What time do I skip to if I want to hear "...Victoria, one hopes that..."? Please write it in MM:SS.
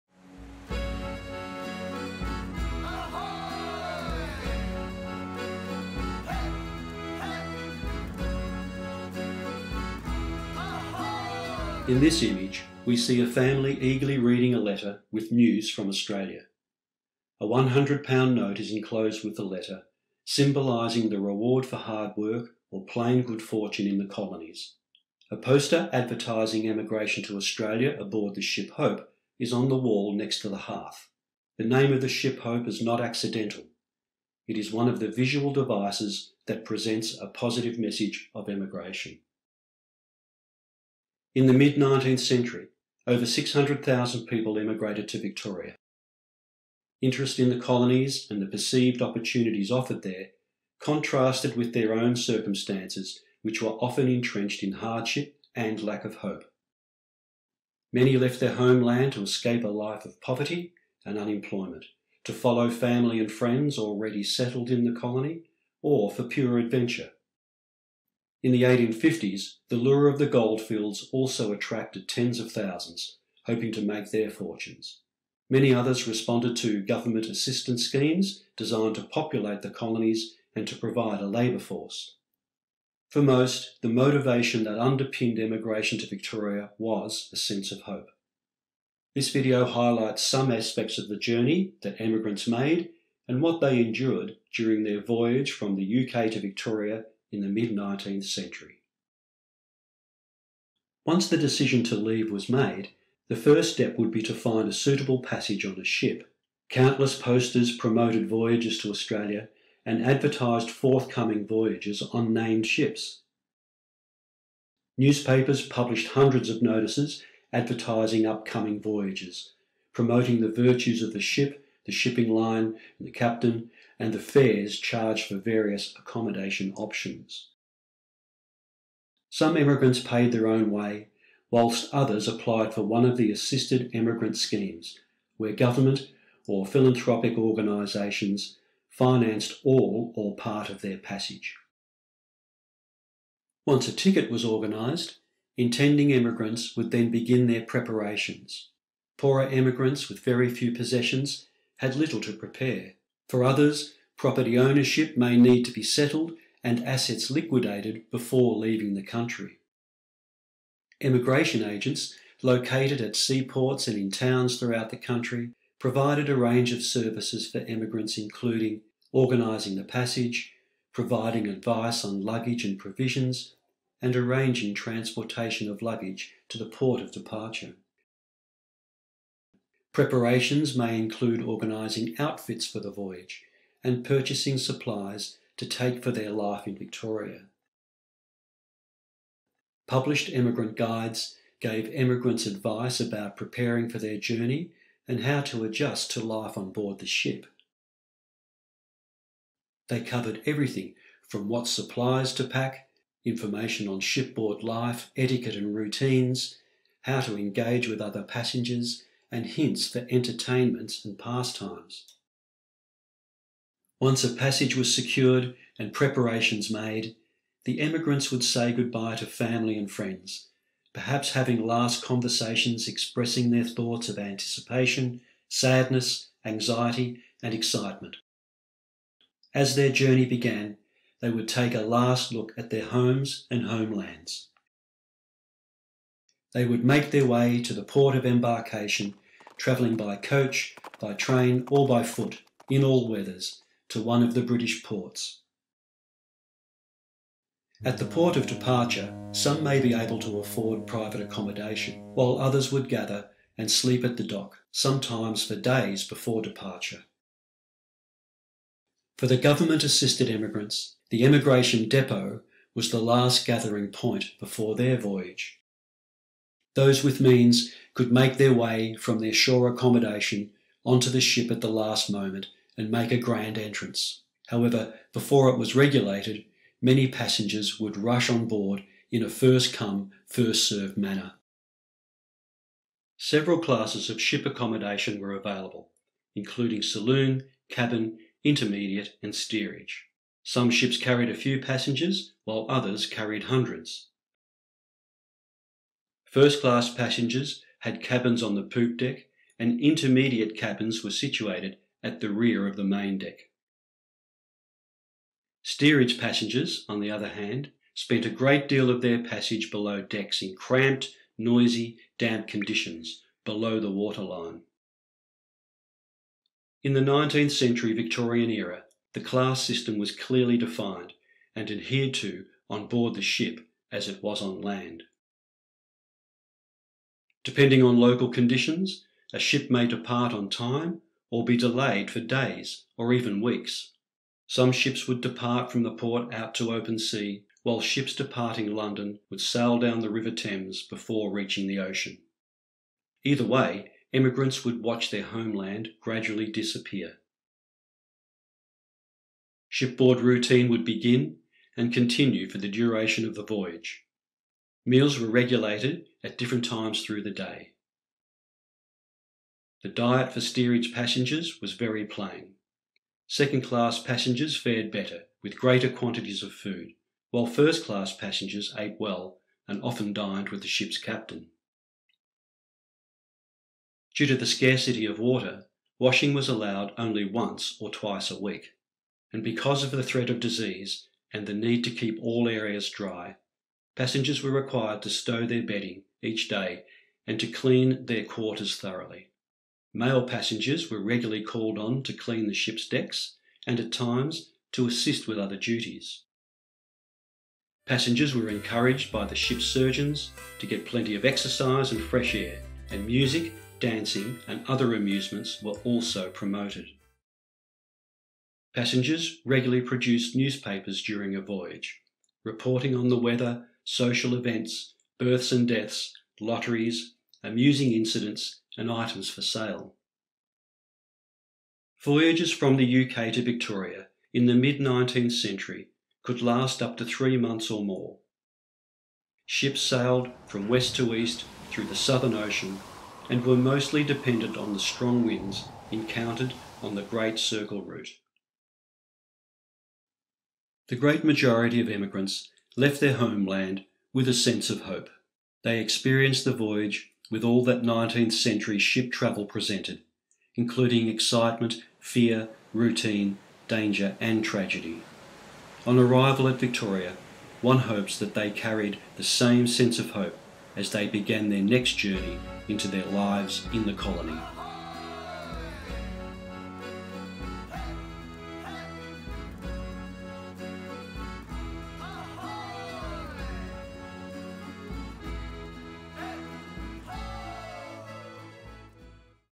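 07:36.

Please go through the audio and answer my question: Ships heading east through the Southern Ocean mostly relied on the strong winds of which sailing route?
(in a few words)
Great Circle route.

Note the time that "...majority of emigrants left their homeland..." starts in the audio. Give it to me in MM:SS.
07:21.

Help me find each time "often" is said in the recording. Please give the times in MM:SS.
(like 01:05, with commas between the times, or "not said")
00:53, 06:09.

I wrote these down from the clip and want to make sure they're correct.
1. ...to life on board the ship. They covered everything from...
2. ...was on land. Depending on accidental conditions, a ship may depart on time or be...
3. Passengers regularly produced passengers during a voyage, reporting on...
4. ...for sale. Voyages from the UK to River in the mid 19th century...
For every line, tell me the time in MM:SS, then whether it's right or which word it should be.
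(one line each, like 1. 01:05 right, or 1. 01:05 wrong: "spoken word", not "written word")
1. 03:16 right
2. 05:24 wrong: "local", not "accidental"
3. 06:48 wrong: "newspapers", not "passengers"
4. 06:59 wrong: "Victoria", not "River".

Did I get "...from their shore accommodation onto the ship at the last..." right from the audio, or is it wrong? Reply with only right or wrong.
right.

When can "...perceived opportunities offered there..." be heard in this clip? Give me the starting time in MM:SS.
00:48.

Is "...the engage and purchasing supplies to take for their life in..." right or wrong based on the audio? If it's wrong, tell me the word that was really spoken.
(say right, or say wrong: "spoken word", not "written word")
wrong: "voyage", not "engage".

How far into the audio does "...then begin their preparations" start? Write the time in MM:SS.
02:26.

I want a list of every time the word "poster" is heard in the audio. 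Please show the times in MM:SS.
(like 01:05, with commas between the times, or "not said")
00:25, 01:47.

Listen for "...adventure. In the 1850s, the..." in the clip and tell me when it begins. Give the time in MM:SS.
01:06.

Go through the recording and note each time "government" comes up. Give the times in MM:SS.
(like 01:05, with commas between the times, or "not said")
01:16, 02:15, 04:19.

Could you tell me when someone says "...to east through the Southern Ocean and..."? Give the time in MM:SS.
07:10.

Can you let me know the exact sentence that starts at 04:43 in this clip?
Several classes of ship accommodation were available, including saloon, cabin, intermediate, and steerage.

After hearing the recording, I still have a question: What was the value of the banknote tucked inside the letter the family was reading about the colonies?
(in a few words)
£100.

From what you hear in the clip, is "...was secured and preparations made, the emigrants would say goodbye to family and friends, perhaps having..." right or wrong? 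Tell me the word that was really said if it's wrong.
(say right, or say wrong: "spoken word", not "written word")
right.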